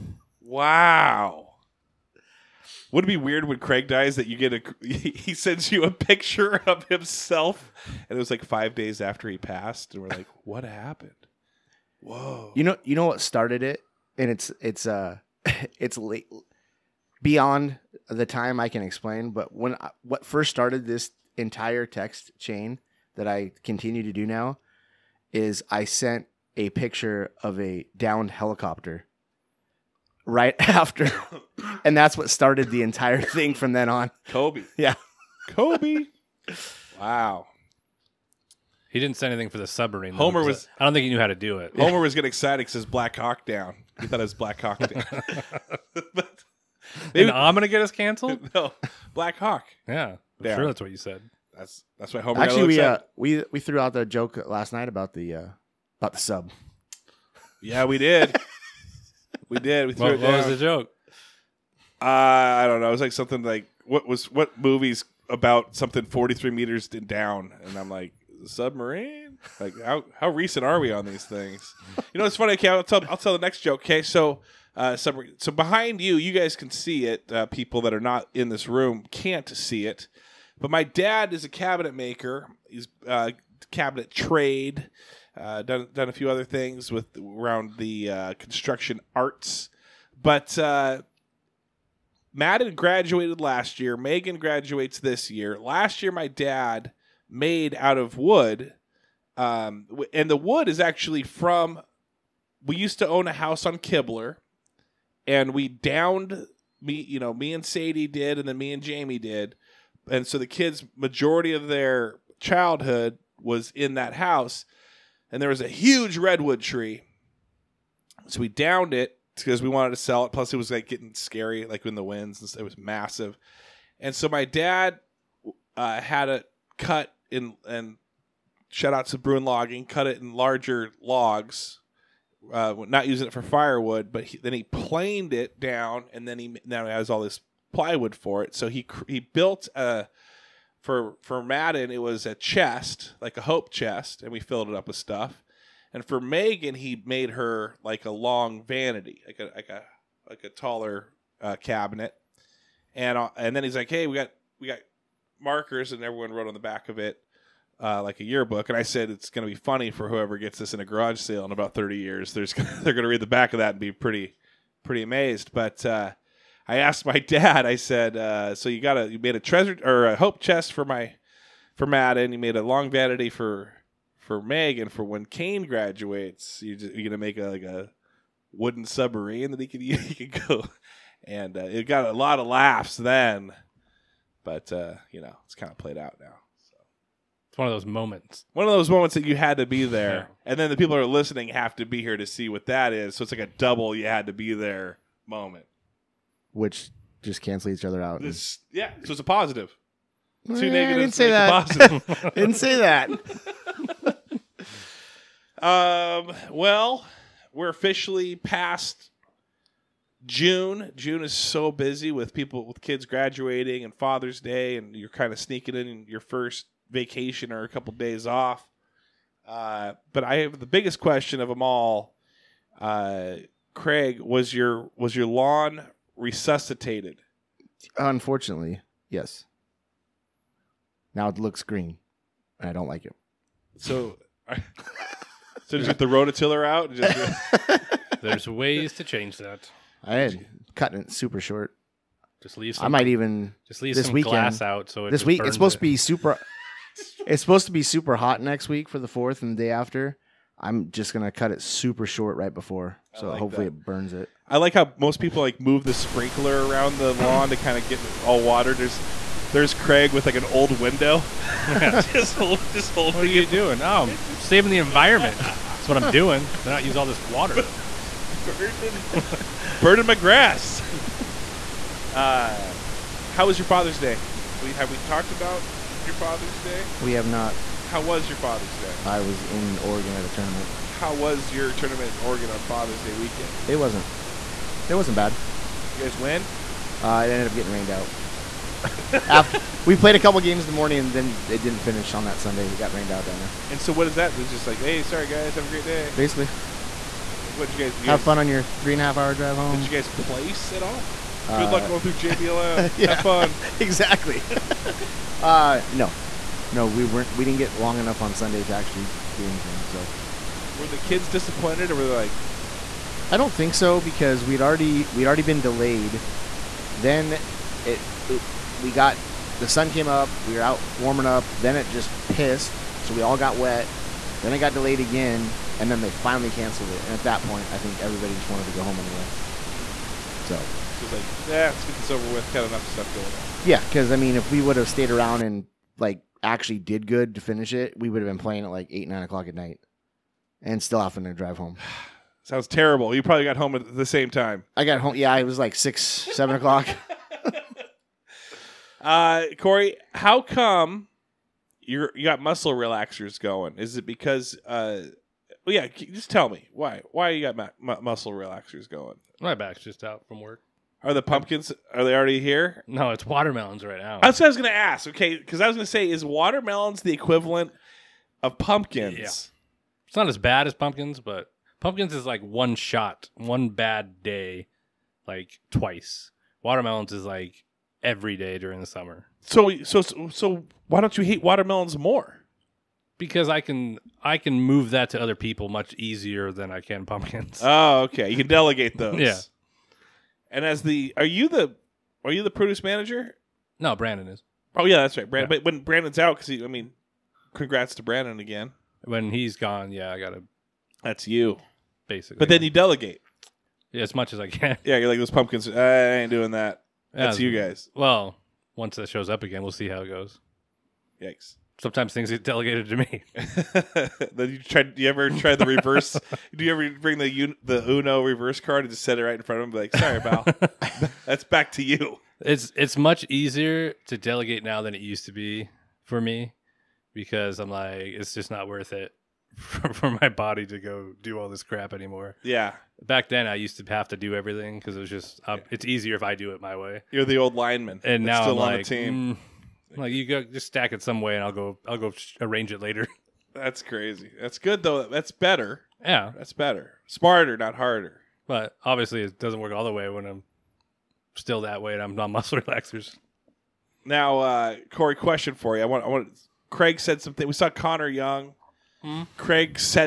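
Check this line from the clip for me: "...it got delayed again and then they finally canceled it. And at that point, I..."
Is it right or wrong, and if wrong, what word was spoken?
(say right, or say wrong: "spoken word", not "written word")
right.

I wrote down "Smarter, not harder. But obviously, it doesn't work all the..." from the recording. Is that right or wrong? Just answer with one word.
right.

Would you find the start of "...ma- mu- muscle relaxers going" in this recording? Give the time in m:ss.
5:57.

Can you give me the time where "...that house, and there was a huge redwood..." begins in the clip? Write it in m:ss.
1:53.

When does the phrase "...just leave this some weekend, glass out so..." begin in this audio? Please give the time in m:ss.
4:03.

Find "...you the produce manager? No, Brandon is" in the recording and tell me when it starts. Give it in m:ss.
6:32.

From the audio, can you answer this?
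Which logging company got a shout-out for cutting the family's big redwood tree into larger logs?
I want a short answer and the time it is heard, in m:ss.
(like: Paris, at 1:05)
Bruin Logging, at 2:09.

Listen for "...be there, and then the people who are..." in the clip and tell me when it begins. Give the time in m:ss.
3:09.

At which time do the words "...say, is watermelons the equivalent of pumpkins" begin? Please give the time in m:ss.
6:05.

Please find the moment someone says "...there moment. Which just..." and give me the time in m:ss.
3:14.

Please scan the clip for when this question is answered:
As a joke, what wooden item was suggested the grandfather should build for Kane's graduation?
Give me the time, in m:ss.
2:58.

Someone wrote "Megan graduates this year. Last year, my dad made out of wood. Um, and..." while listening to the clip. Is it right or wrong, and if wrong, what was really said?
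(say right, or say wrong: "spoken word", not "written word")
right.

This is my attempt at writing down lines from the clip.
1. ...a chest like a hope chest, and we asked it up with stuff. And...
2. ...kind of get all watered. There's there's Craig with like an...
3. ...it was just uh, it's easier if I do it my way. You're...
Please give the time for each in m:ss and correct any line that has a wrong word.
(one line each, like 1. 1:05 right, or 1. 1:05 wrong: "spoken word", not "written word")
1. 2:22 wrong: "filled", not "asked"
2. 4:17 right
3. 7:14 right.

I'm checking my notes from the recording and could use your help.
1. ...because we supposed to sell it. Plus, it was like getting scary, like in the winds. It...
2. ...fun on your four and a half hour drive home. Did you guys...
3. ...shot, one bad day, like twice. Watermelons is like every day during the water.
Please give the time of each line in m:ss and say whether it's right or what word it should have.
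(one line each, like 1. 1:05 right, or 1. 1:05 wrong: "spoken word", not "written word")
1. 1:59 wrong: "wanted", not "supposed"
2. 4:58 wrong: "three", not "four"
3. 6:12 wrong: "summer", not "water".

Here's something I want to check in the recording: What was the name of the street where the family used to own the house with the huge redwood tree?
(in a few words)
Kibler.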